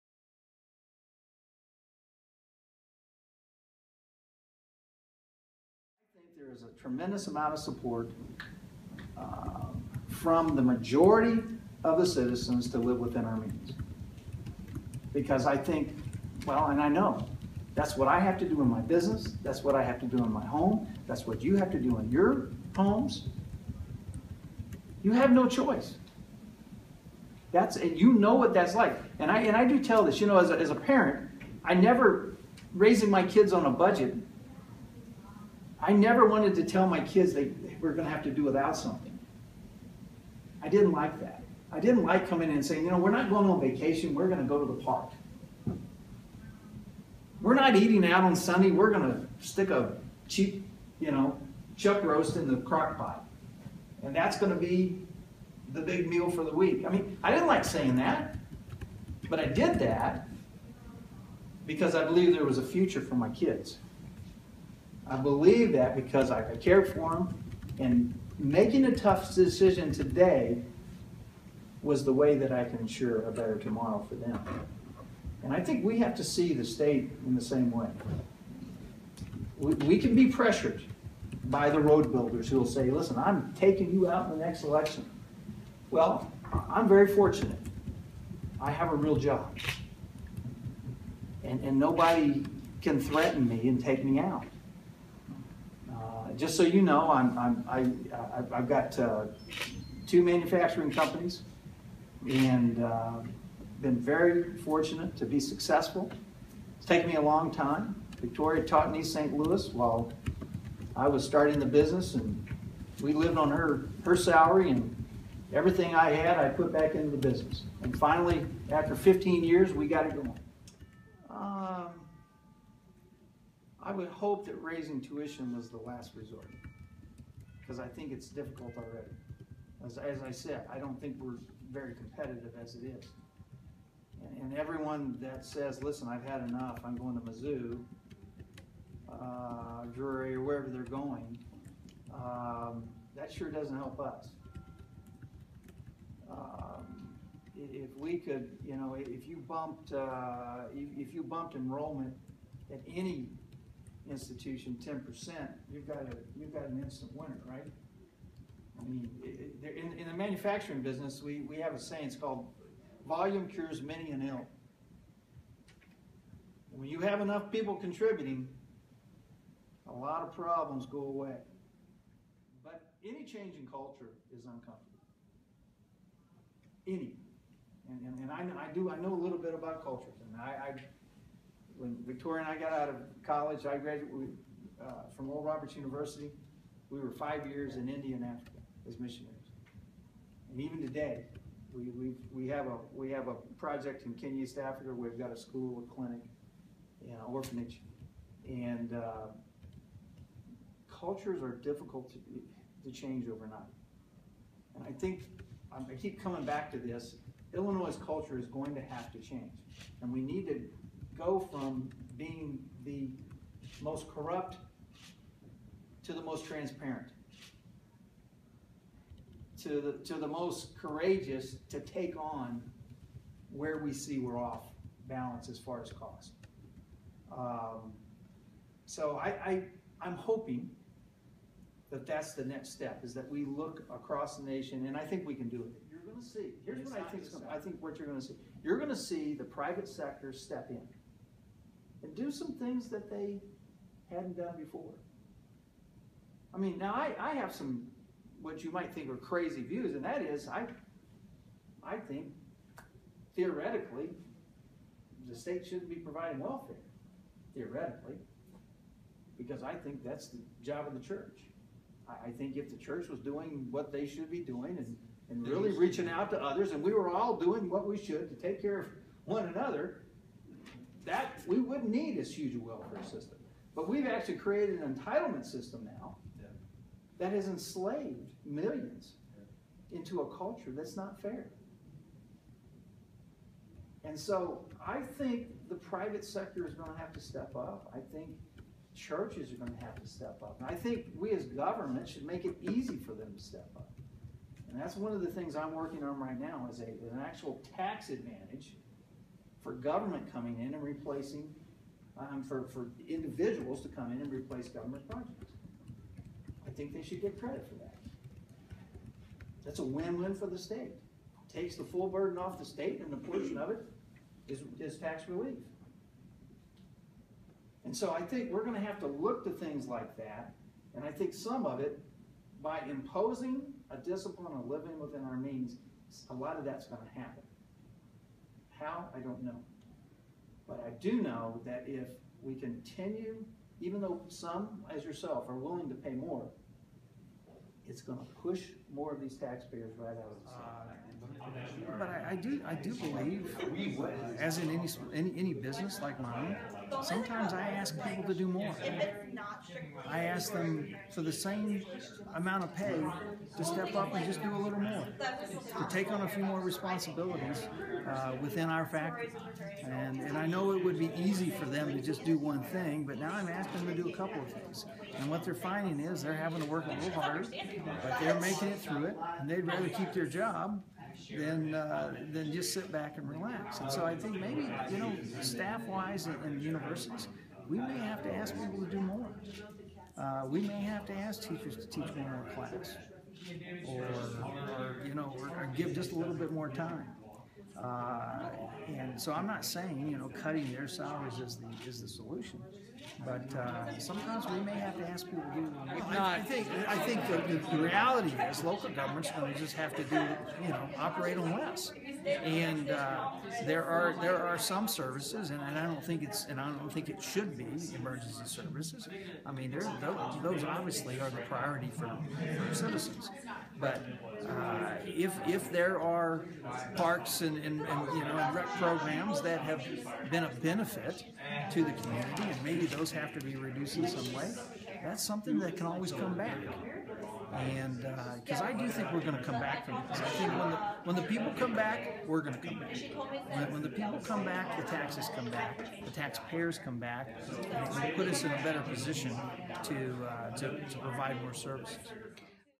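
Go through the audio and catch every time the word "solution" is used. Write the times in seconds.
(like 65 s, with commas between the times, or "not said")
392 s.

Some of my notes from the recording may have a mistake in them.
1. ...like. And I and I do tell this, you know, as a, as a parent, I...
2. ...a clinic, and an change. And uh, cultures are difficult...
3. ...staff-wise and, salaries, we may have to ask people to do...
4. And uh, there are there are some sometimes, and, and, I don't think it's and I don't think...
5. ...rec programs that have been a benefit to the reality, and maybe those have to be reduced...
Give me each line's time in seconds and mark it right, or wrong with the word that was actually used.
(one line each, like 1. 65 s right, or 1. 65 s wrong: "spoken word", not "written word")
1. 28 s right
2. 195 s wrong: "orphanage", not "change"
3. 375 s wrong: "universities", not "salaries"
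4. 402 s wrong: "services", not "sometimes"
5. 418 s wrong: "community", not "reality".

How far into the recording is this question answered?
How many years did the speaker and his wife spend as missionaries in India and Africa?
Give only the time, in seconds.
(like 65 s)
187 s.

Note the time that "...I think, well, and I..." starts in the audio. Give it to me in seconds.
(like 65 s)
15 s.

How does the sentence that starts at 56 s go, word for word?
I mean, I didn't like saying that, but I did that because I believe there was a future for my kids.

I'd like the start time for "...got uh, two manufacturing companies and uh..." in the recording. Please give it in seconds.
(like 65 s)
98 s.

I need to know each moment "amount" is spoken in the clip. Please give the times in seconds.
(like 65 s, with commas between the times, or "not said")
7 s, 352 s.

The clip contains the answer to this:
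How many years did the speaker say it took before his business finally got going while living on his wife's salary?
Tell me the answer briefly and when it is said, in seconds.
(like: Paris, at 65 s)
15, at 118 s.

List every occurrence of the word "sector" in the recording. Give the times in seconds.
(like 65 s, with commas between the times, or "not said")
239 s, 286 s.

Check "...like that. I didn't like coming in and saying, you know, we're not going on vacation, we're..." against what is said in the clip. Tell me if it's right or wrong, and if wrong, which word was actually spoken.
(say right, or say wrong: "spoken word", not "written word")
right.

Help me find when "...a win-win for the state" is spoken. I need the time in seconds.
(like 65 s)
309 s.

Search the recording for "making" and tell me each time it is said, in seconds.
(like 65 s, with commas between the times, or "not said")
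68 s, 368 s.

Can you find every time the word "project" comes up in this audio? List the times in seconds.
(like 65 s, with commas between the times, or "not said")
193 s, 305 s.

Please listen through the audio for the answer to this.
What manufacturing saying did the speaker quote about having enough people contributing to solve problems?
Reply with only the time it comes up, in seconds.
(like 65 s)
163 s.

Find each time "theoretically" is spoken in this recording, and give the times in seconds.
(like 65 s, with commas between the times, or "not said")
253 s, 257 s.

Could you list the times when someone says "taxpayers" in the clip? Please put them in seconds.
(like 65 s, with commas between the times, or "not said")
339 s, 436 s.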